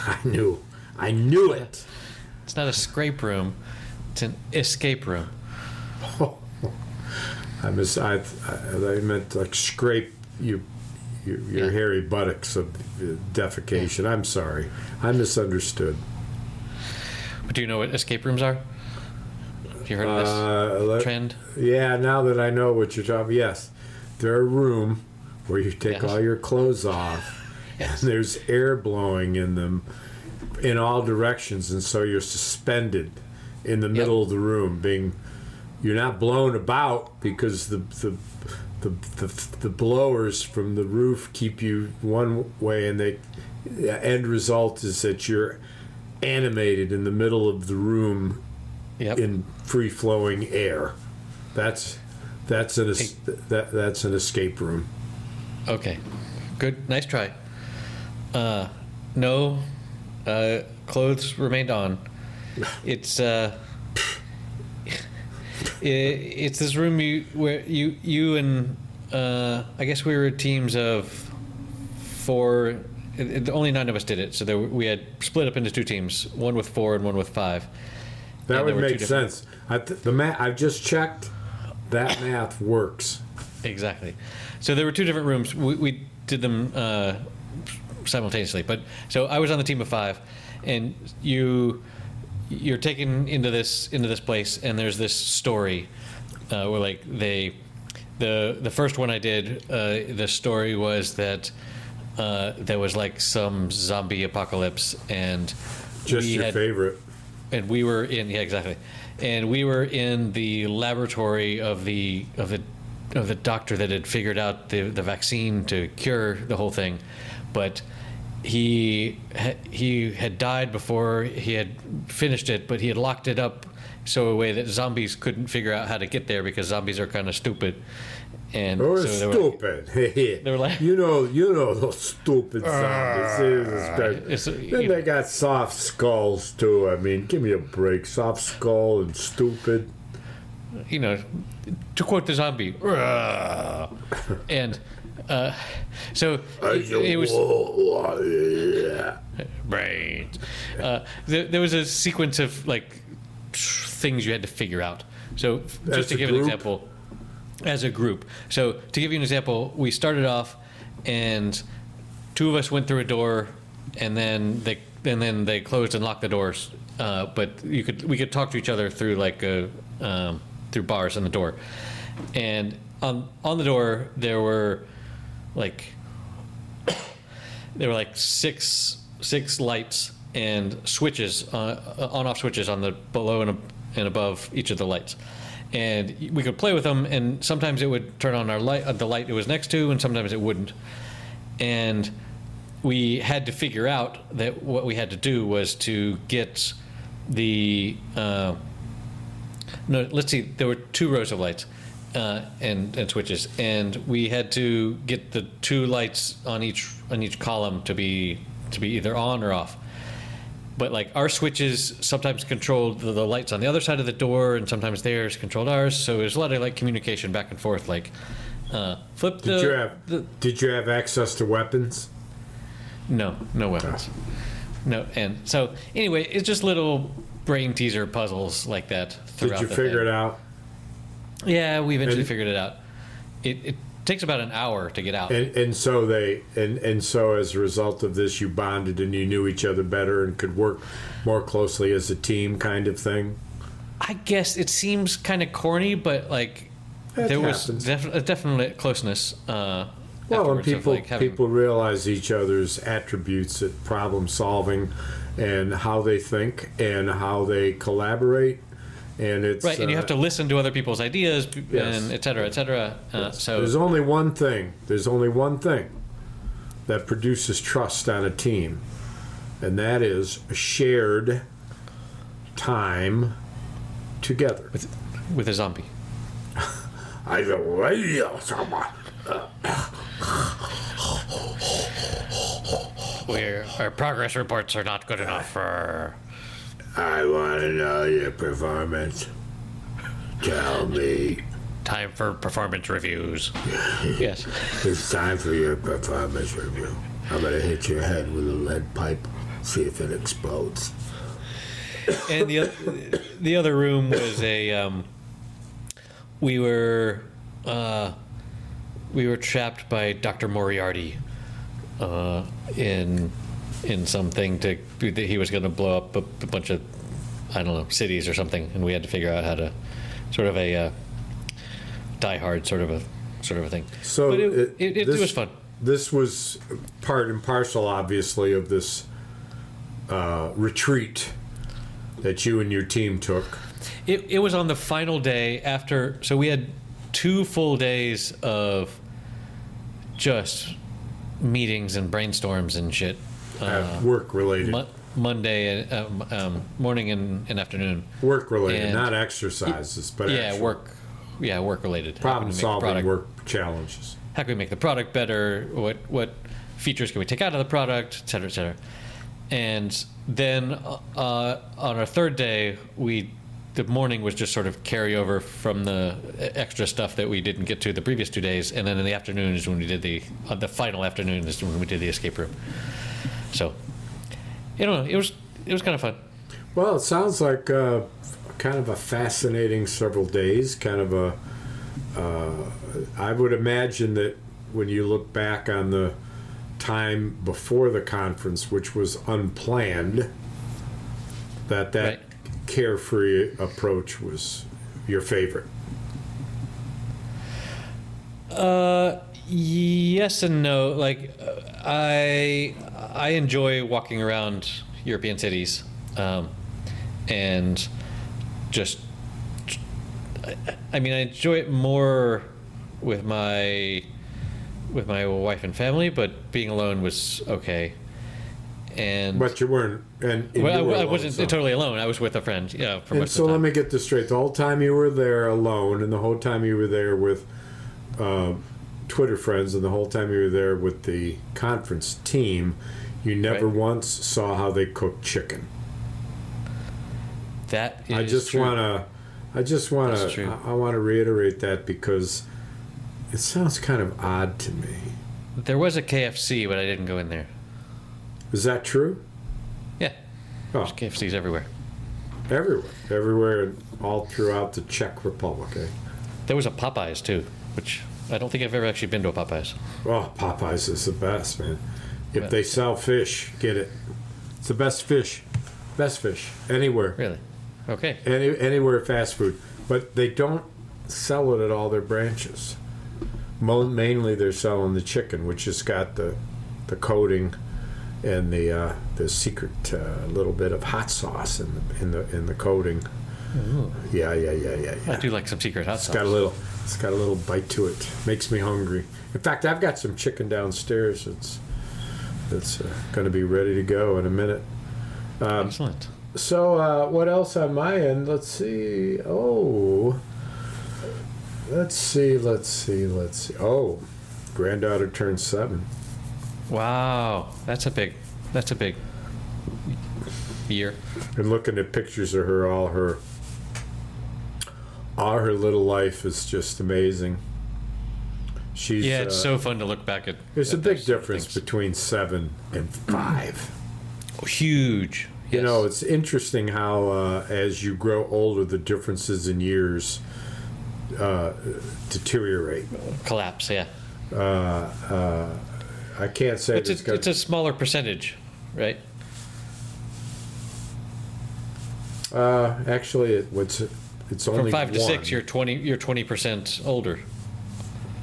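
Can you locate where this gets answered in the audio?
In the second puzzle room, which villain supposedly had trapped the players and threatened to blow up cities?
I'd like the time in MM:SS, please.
05:10.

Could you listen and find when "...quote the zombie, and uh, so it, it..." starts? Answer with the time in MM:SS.
02:22.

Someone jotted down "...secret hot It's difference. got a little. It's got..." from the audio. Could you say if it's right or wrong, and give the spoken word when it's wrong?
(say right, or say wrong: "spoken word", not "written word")
wrong: "sauce", not "difference".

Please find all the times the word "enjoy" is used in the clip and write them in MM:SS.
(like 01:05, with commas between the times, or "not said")
06:43, 06:51.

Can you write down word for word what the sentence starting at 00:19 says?
Have you heard of this uh, trend?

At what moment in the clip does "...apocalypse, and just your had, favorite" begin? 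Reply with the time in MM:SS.
01:44.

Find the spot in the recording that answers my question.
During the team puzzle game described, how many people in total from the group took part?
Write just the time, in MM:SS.
01:13.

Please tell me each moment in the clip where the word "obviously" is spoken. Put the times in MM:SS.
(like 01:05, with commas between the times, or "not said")
05:27.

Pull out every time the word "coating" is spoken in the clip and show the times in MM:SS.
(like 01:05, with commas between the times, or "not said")
07:56, 08:02.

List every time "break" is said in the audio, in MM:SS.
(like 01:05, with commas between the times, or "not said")
02:17.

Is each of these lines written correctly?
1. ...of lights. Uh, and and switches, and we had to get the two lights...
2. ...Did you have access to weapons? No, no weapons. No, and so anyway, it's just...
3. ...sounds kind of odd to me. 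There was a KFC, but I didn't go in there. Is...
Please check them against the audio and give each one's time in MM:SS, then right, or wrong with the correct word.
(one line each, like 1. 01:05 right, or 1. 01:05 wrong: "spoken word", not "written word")
1. 03:21 right
2. 03:40 right
3. 07:23 right.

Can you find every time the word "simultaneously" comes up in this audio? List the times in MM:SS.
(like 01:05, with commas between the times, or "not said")
01:28.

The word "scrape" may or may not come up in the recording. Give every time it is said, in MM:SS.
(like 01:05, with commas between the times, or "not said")
00:02, 00:09.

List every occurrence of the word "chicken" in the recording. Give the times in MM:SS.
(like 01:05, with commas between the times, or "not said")
07:15, 07:55, 08:10.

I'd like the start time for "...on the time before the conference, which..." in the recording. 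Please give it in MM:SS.
06:25.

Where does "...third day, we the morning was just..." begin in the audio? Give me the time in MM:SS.
06:02.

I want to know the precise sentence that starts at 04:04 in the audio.
I guess it seems kind of corny, but like that there happens.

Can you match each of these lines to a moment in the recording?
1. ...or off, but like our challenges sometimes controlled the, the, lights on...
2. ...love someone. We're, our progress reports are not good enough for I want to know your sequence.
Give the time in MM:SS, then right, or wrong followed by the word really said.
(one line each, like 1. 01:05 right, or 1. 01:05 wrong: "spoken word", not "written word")
1. 03:29 wrong: "switches", not "challenges"
2. 04:37 wrong: "performance", not "sequence".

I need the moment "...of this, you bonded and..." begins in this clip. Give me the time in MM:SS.
03:58.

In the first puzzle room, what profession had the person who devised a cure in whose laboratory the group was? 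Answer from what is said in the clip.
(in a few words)
Doctor.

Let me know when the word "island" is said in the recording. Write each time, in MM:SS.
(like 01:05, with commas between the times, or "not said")
not said.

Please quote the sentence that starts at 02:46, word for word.
Uh, but you could we could talk to each other through like a, um, through bars on the door.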